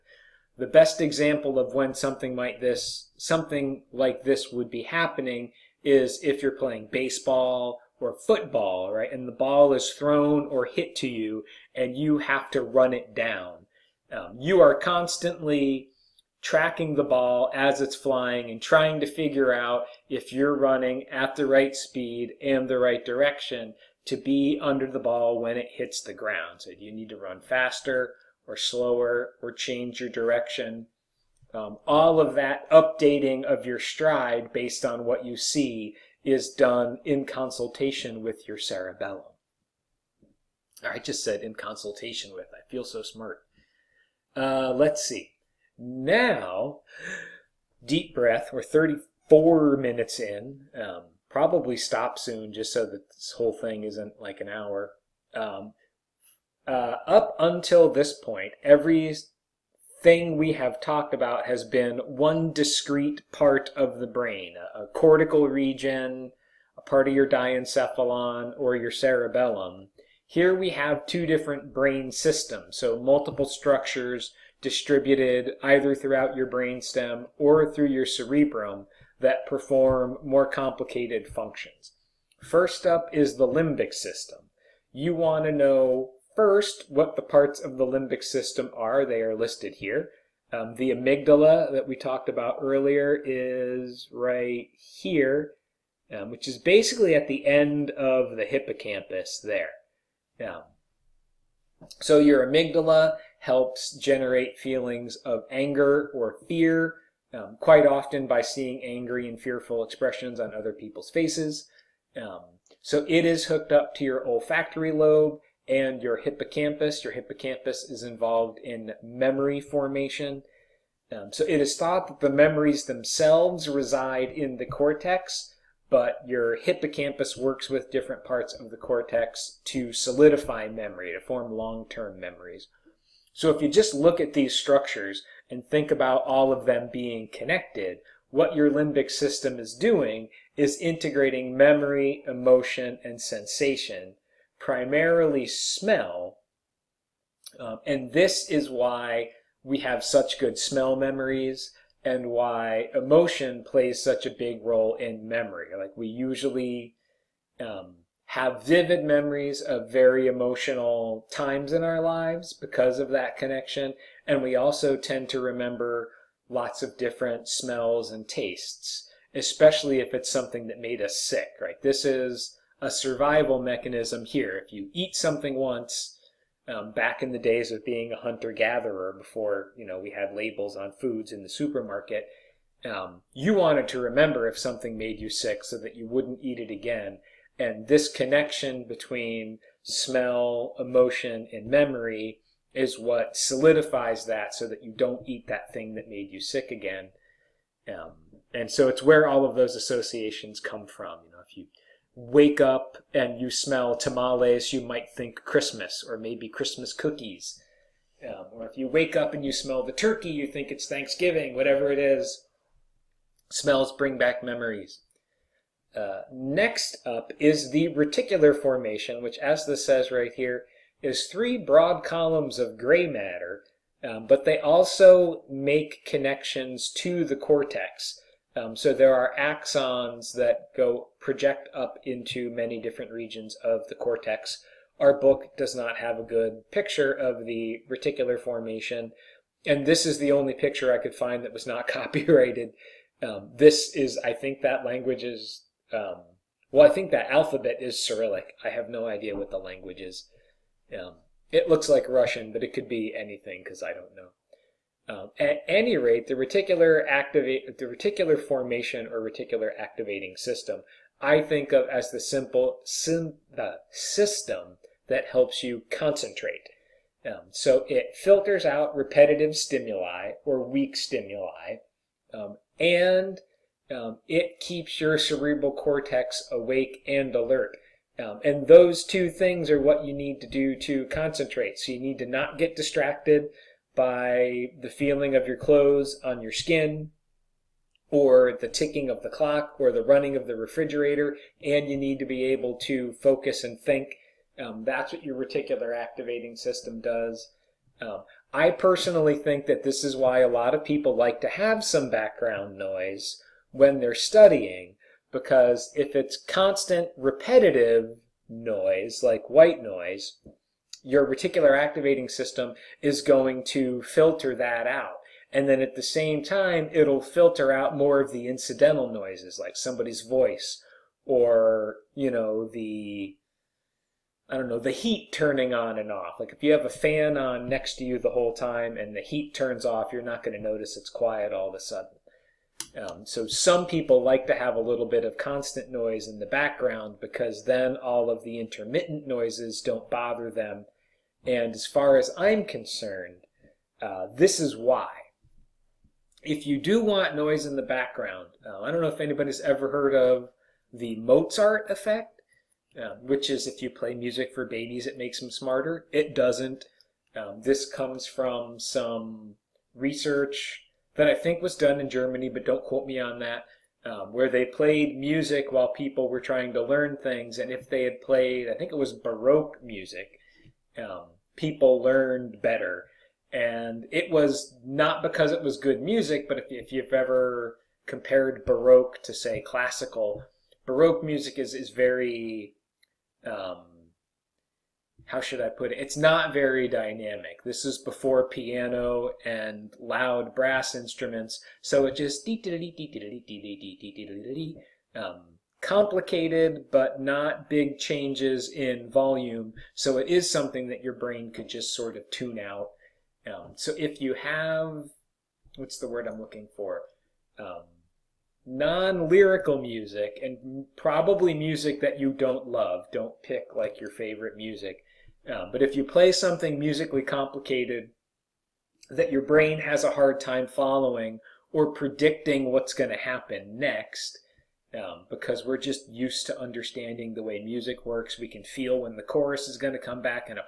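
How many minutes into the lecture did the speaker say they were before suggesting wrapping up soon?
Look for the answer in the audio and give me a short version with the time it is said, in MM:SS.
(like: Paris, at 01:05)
34, at 00:48.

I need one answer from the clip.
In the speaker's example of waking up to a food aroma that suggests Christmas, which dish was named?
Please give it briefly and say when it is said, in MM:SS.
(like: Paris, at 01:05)
Tamales, at 03:23.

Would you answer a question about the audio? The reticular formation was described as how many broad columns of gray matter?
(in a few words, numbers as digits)
3.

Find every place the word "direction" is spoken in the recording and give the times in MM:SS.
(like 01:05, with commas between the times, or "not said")
00:23, 00:30.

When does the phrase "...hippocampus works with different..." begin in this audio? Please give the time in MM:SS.
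02:06.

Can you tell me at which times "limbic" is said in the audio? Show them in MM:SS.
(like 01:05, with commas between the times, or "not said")
01:23, 01:27, 02:18.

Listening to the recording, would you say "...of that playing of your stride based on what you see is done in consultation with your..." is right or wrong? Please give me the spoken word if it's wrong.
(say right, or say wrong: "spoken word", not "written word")
wrong: "updating", not "playing".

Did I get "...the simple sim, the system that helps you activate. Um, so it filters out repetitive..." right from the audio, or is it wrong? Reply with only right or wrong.
wrong.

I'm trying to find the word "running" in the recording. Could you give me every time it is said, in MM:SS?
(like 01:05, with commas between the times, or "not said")
00:20, 04:50.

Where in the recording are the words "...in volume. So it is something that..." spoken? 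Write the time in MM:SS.
06:38.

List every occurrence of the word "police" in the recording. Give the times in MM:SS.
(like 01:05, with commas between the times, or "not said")
not said.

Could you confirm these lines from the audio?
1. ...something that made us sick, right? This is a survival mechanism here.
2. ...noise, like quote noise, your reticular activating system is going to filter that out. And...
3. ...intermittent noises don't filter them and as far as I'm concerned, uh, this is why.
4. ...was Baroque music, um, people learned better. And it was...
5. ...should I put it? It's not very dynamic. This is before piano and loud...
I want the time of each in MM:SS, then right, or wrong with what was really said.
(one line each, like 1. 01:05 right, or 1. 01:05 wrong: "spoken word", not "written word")
1. 02:50 right
2. 05:08 wrong: "white", not "quote"
3. 05:38 wrong: "bother", not "filter"
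4. 06:08 right
5. 06:25 right.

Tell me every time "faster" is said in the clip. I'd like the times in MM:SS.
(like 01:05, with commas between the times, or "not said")
00:27.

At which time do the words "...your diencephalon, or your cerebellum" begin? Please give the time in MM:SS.
01:07.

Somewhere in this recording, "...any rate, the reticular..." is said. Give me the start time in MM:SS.
04:15.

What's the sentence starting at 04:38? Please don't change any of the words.
Um, and those two things are what you need to do to concentrate.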